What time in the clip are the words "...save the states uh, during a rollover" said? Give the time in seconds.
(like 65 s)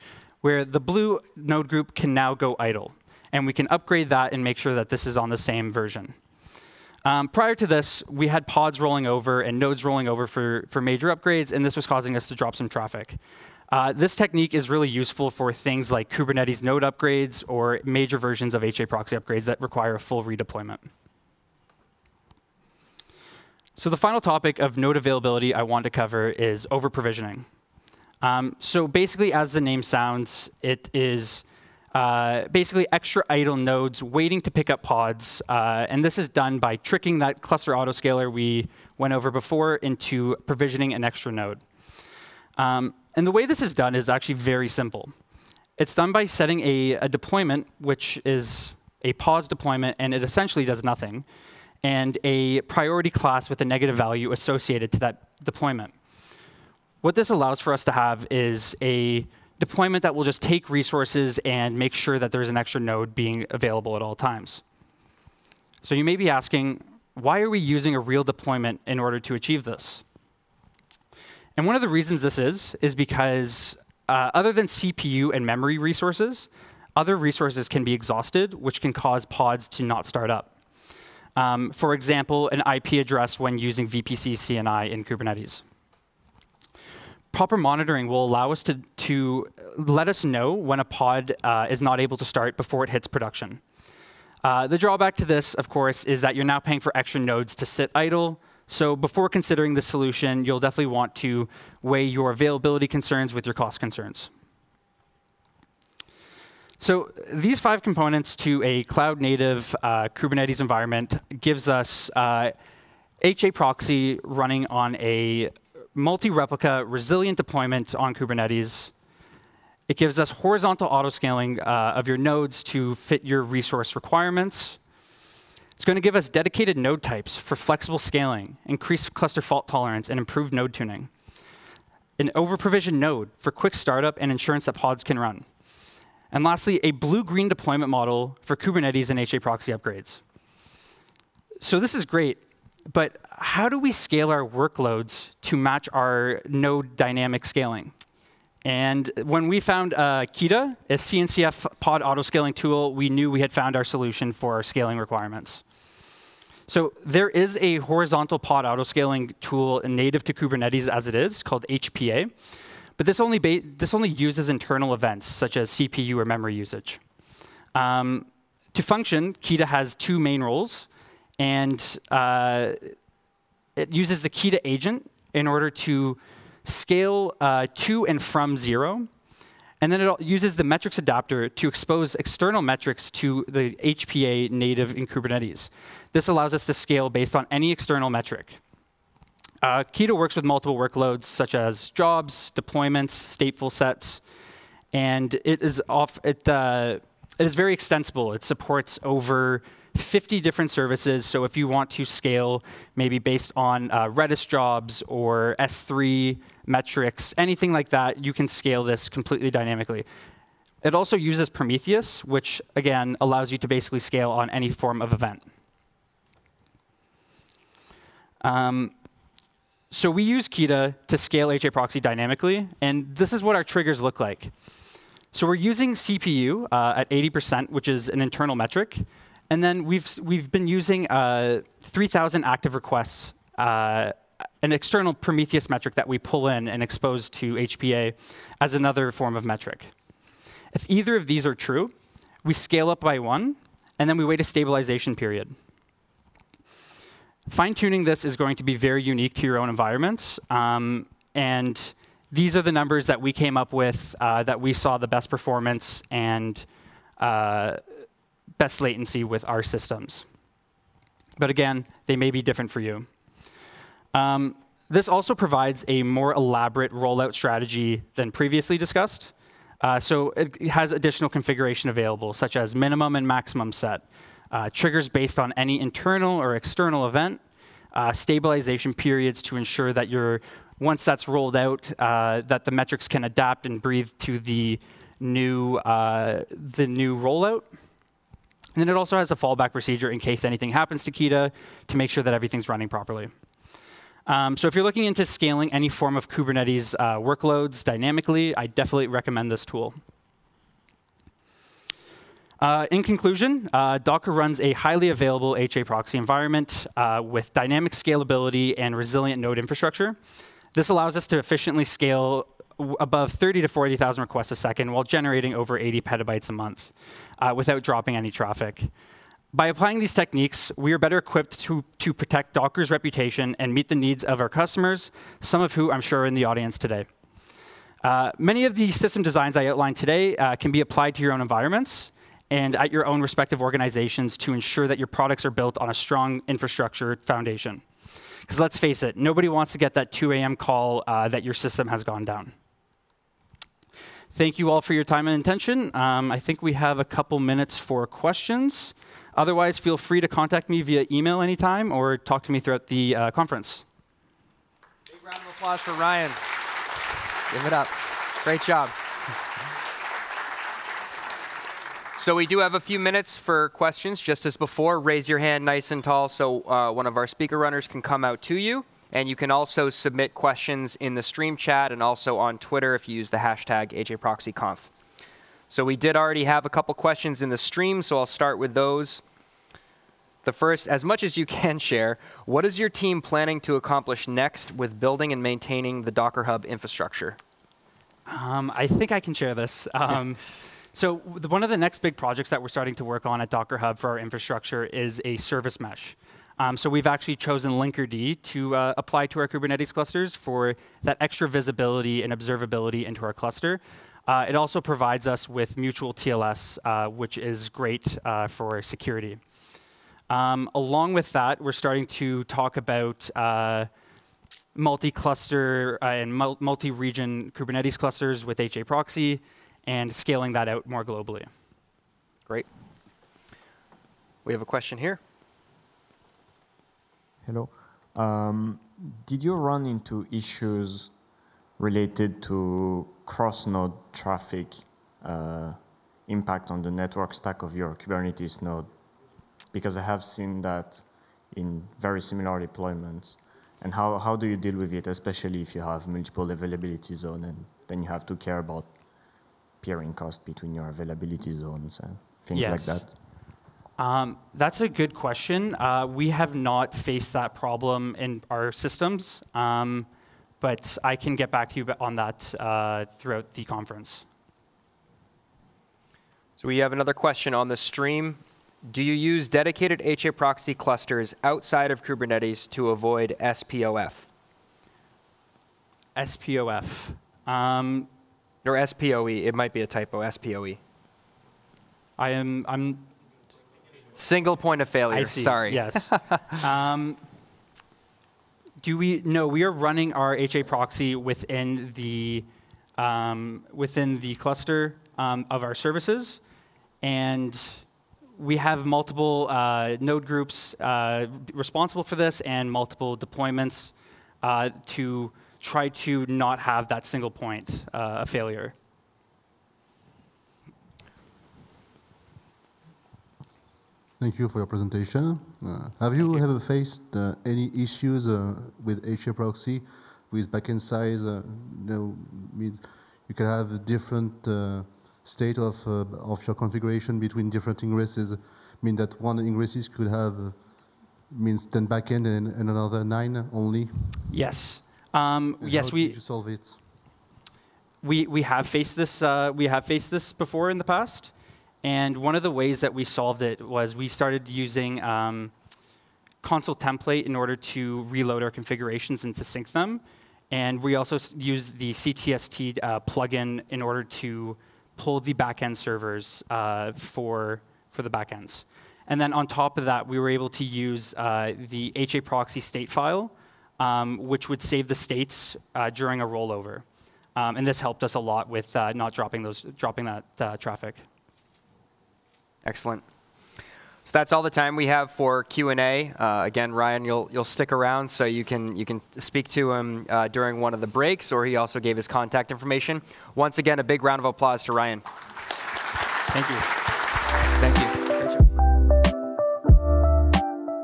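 564 s.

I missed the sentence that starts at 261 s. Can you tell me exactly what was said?
But again, they may be different for you.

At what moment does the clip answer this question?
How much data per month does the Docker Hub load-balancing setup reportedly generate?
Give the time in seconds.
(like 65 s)
315 s.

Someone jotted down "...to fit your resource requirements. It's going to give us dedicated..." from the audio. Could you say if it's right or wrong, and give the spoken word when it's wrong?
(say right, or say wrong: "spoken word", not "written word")
right.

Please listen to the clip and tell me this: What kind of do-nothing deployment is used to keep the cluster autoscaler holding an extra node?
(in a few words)
Pause deployment.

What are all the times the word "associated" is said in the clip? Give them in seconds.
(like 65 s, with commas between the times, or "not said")
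54 s.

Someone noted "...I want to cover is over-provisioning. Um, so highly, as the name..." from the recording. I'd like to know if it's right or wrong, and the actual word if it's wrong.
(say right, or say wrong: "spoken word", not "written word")
wrong: "basically", not "highly".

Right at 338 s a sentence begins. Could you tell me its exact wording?
Because let's face it, nobody wants to get that 2 a.m.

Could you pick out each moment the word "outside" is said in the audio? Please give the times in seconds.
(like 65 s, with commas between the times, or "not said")
471 s.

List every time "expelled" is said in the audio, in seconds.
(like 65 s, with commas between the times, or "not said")
not said.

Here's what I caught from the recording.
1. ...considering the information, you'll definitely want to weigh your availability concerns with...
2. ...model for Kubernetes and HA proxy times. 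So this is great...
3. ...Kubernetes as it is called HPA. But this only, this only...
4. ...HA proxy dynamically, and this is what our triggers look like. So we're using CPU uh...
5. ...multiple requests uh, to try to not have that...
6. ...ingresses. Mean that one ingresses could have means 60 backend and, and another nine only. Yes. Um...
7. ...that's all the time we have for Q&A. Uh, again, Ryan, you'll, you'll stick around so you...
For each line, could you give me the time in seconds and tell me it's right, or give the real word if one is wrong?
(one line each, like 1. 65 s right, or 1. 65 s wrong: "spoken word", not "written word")
1. 99 s wrong: "solution", not "information"
2. 137 s wrong: "upgrades", not "times"
3. 160 s right
4. 221 s right
5. 502 s wrong: "deployments", not "requests"
6. 527 s wrong: "10", not "60"
7. 574 s right.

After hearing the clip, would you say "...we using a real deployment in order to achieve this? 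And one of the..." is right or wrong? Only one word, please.
right.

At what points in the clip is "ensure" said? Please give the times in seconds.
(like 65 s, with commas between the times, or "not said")
279 s, 334 s.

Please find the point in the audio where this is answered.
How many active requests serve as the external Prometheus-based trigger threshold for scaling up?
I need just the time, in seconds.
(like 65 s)
231 s.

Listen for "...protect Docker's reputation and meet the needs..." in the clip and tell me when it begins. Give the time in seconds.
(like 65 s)
322 s.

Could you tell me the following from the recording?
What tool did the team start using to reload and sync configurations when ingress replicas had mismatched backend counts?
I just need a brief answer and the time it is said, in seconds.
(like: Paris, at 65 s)
consul-template, at 546 s.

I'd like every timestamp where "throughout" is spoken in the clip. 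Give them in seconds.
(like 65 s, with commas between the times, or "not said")
352 s, 463 s.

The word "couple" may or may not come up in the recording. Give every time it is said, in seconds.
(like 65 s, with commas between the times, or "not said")
347 s, 376 s.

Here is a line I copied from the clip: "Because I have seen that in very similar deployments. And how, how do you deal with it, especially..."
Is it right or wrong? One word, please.
right.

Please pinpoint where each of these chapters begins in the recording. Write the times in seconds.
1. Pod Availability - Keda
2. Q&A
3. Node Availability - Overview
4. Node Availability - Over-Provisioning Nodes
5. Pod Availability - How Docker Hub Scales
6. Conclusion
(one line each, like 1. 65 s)
1. 148 s
2. 361 s
3. 105 s
4. 22 s
5. 217 s
6. 301 s.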